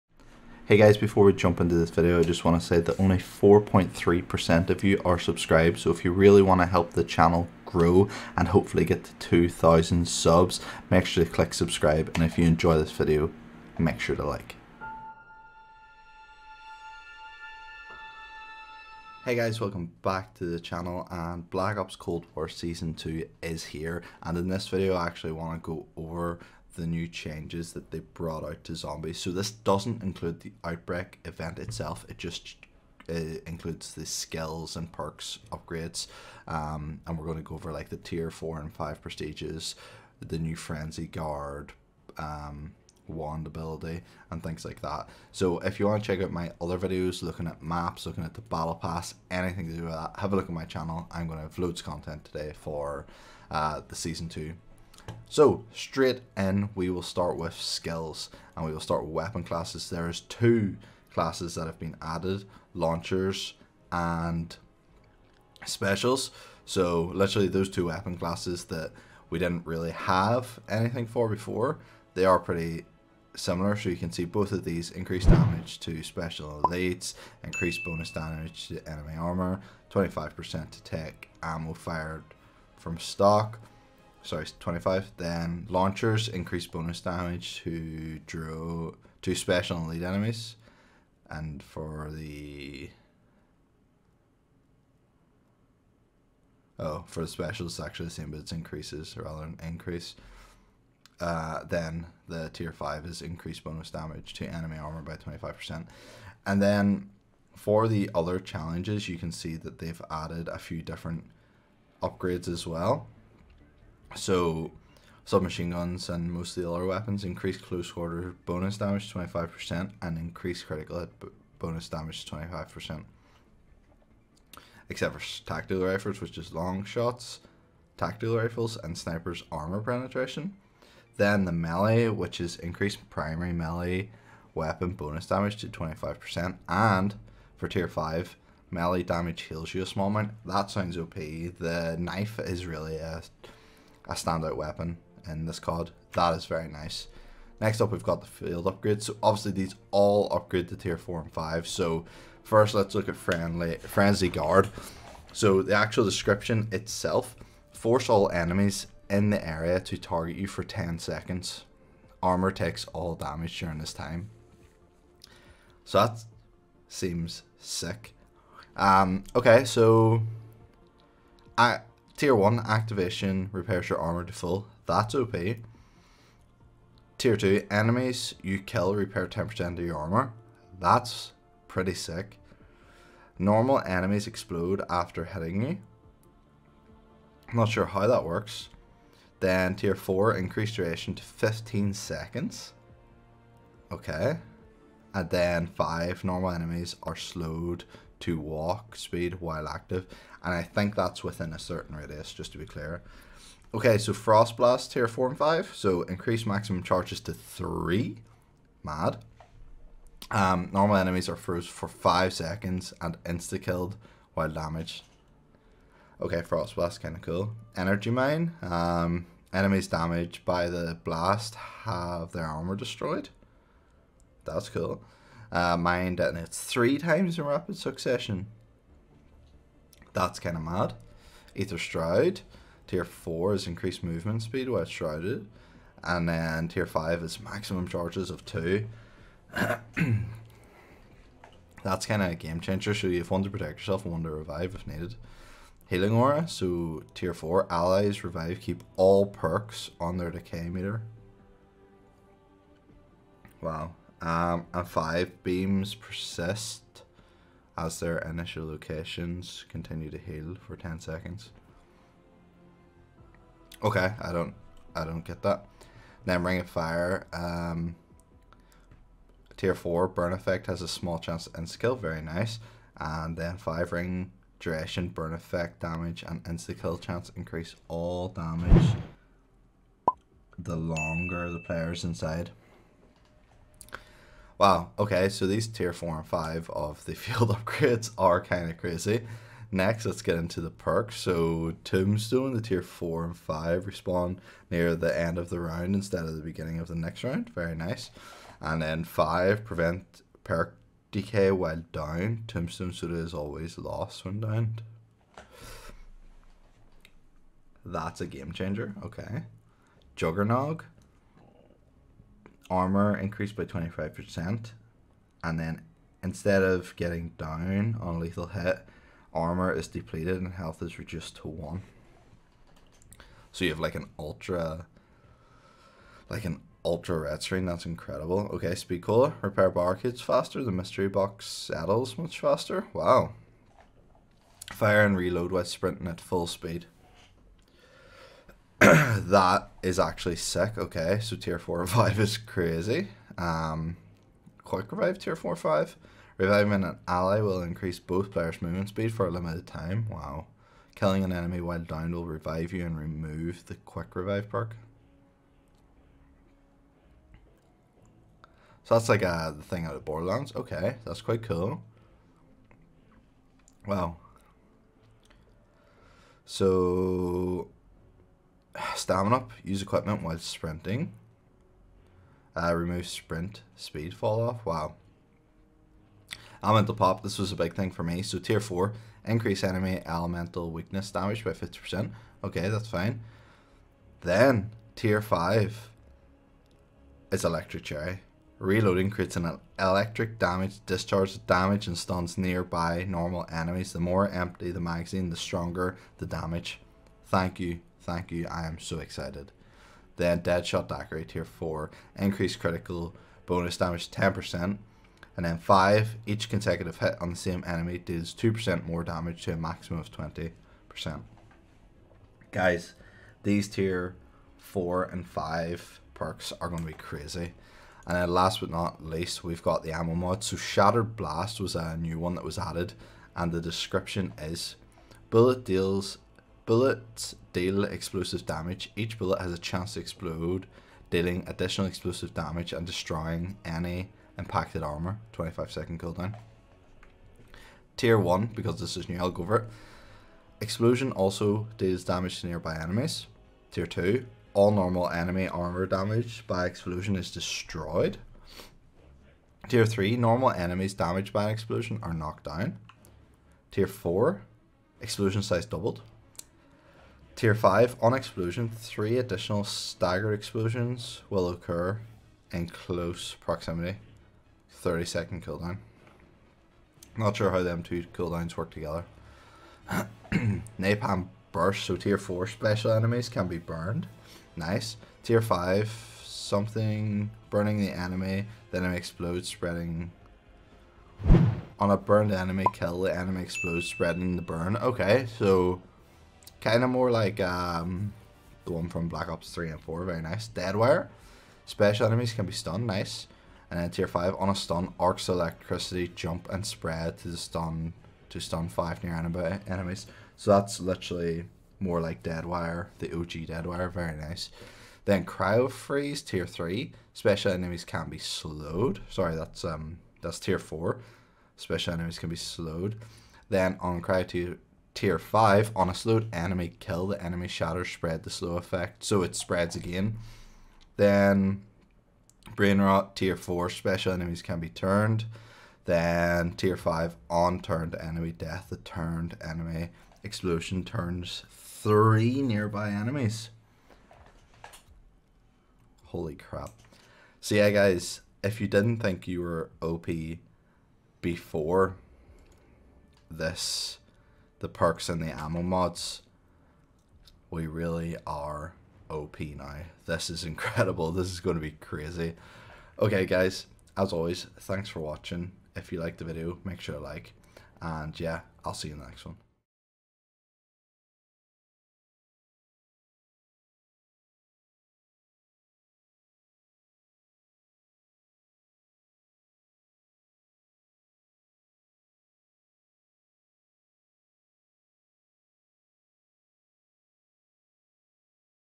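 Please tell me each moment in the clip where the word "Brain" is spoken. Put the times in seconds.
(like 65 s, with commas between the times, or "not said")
522 s.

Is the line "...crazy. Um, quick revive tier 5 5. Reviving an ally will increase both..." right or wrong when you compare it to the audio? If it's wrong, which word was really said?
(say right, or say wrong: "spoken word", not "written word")
wrong: "4", not "5".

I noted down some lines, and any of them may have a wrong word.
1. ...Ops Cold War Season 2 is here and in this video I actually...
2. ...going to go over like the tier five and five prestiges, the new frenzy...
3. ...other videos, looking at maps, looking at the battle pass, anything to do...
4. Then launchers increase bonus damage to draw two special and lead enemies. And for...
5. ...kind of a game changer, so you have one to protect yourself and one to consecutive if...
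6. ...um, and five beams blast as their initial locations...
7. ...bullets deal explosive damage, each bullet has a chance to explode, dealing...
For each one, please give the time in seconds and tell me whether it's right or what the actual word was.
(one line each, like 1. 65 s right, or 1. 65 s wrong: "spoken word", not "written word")
1. 21 s right
2. 37 s wrong: "four", not "five"
3. 46 s right
4. 85 s right
5. 242 s wrong: "revive", not "consecutive"
6. 254 s wrong: "persist", not "blast"
7. 426 s right.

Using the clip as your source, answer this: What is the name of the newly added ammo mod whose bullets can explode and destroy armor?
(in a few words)
Shattered Blast.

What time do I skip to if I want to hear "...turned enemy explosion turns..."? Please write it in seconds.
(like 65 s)
528 s.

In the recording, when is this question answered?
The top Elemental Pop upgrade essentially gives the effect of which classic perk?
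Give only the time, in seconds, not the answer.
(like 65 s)
387 s.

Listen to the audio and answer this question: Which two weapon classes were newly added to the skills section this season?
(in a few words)
launchers and specials.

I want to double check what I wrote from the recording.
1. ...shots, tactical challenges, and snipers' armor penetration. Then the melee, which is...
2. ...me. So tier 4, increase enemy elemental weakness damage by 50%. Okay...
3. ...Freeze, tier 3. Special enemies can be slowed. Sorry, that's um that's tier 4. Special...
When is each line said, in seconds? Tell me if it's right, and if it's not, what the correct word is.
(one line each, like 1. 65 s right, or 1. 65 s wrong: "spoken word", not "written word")
1. 126 s wrong: "rifles", not "challenges"
2. 378 s right
3. 505 s right.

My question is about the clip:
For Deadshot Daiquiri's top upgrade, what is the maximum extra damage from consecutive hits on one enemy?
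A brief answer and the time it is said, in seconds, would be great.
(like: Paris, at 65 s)
20%, at 410 s.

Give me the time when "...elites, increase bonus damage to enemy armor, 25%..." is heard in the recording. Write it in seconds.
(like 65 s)
76 s.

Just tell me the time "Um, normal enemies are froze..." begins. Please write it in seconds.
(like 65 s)
210 s.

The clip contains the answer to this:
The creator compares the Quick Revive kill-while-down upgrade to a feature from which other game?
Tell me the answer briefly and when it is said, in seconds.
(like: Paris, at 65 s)
Borderlands, at 360 s.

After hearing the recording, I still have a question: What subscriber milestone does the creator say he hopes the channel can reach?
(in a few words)
2,000.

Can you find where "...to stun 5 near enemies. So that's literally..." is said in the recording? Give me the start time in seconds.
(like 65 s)
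498 s.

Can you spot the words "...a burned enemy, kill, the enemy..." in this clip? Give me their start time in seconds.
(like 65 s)
481 s.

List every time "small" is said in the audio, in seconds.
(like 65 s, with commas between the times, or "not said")
139 s, 270 s.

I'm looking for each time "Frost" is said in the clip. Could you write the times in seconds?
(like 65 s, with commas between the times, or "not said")
204 s, 216 s.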